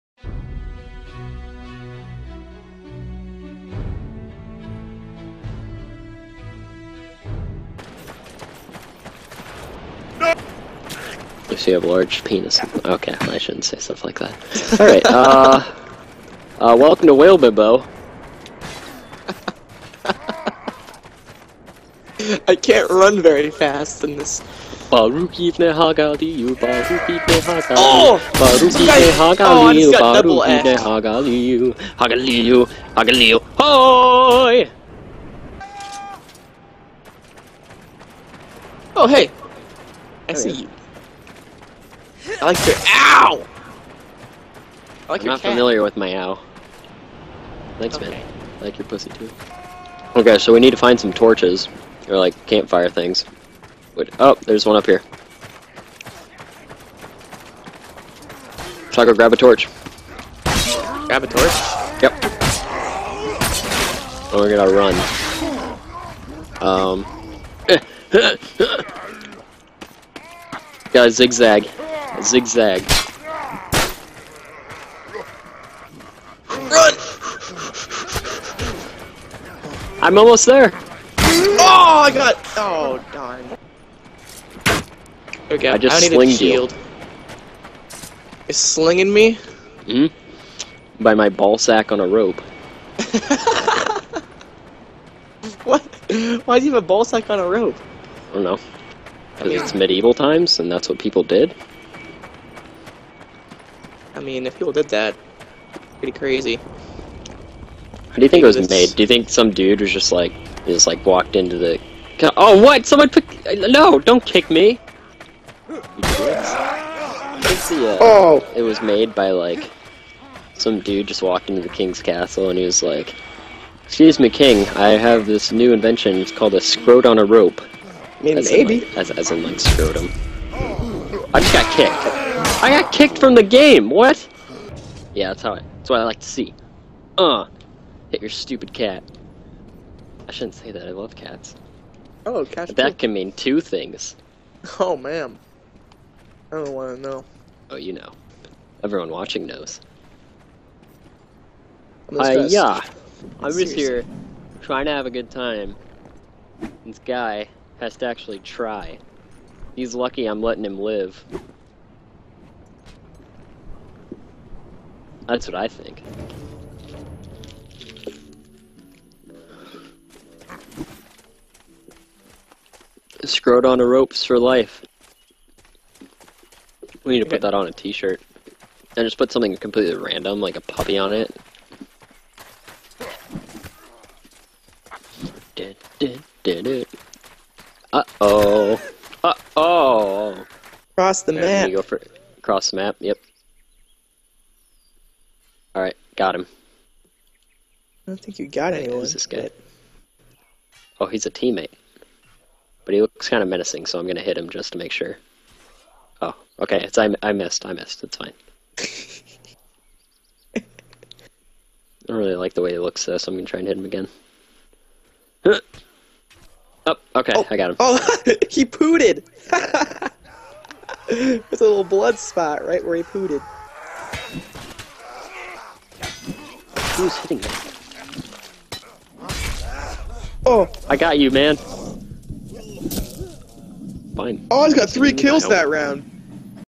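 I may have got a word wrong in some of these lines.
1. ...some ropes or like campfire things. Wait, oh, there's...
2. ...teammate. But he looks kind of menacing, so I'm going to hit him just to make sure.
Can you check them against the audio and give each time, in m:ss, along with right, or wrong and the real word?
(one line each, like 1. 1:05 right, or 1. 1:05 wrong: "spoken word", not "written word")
1. 0:50 wrong: "torches", not "ropes"
2. 3:21 right.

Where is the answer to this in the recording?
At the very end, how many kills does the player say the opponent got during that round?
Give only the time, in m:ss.
3:54.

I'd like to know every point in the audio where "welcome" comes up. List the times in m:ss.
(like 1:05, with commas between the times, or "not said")
0:16.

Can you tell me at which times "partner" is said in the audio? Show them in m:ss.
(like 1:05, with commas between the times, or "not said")
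not said.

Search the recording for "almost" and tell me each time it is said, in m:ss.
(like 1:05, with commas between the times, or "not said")
1:20.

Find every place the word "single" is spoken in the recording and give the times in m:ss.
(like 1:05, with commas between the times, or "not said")
not said.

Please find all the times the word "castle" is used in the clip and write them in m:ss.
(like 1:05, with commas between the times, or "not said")
2:02.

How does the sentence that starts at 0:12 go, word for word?
Okay, I shouldn't say stuff like that.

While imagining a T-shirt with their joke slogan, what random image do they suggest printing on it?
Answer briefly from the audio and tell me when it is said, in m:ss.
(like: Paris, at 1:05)
A puppy, at 3:00.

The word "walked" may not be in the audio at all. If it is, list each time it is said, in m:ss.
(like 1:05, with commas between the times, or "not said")
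1:51, 2:01.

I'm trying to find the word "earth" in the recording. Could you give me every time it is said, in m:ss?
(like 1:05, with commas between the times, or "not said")
not said.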